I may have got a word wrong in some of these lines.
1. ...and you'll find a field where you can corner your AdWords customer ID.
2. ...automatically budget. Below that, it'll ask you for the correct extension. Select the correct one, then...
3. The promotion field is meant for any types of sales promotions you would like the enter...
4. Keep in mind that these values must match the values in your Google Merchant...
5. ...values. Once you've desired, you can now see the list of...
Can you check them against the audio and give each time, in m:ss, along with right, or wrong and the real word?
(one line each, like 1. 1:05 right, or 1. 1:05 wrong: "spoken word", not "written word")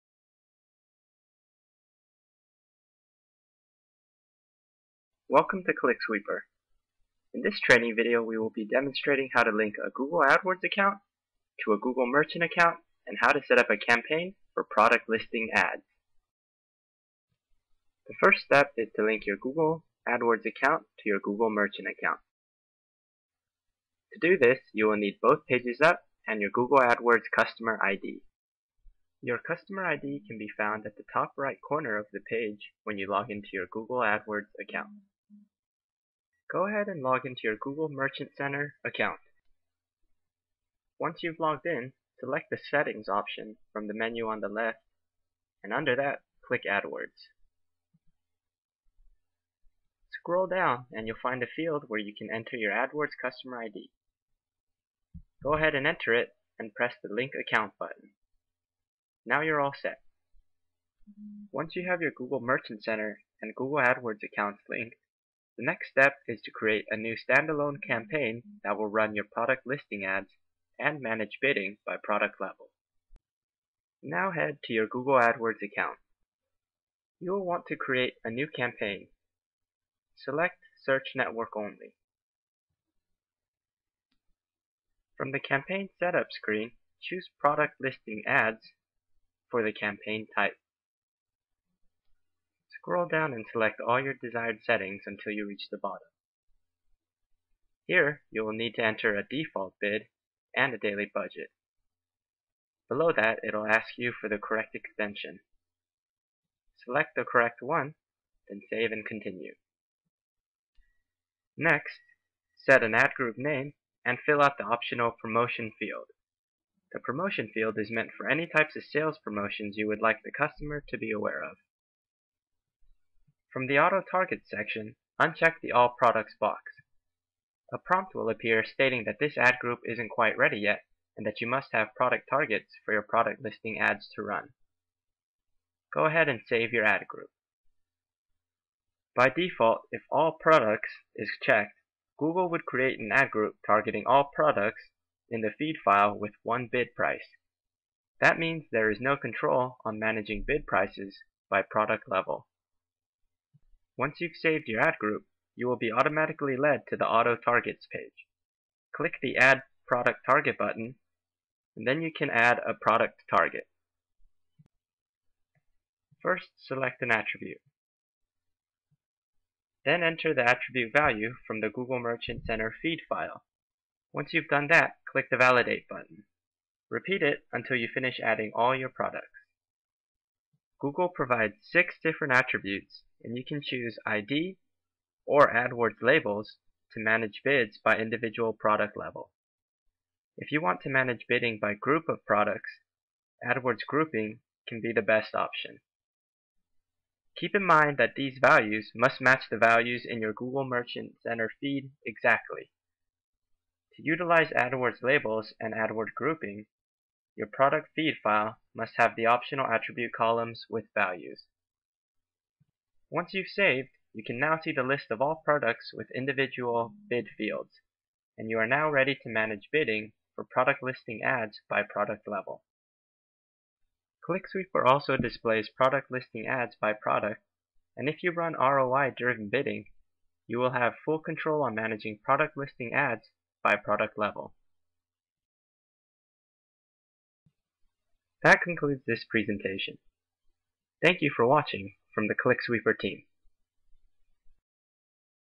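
1. 0:50 wrong: "enter", not "corner"
2. 1:40 wrong: "daily", not "automatically"
3. 1:56 wrong: "customer", not "enter"
4. 3:17 right
5. 3:30 wrong: "saved", not "desired".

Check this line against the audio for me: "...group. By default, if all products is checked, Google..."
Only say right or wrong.
right.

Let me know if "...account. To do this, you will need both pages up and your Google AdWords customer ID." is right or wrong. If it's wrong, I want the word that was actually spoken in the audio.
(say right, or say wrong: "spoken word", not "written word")
right.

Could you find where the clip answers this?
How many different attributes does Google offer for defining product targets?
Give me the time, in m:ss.
3:01.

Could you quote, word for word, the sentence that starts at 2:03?
From the Auto Target section, uncheck the All Products box.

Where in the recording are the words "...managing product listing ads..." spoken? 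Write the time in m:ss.
3:51.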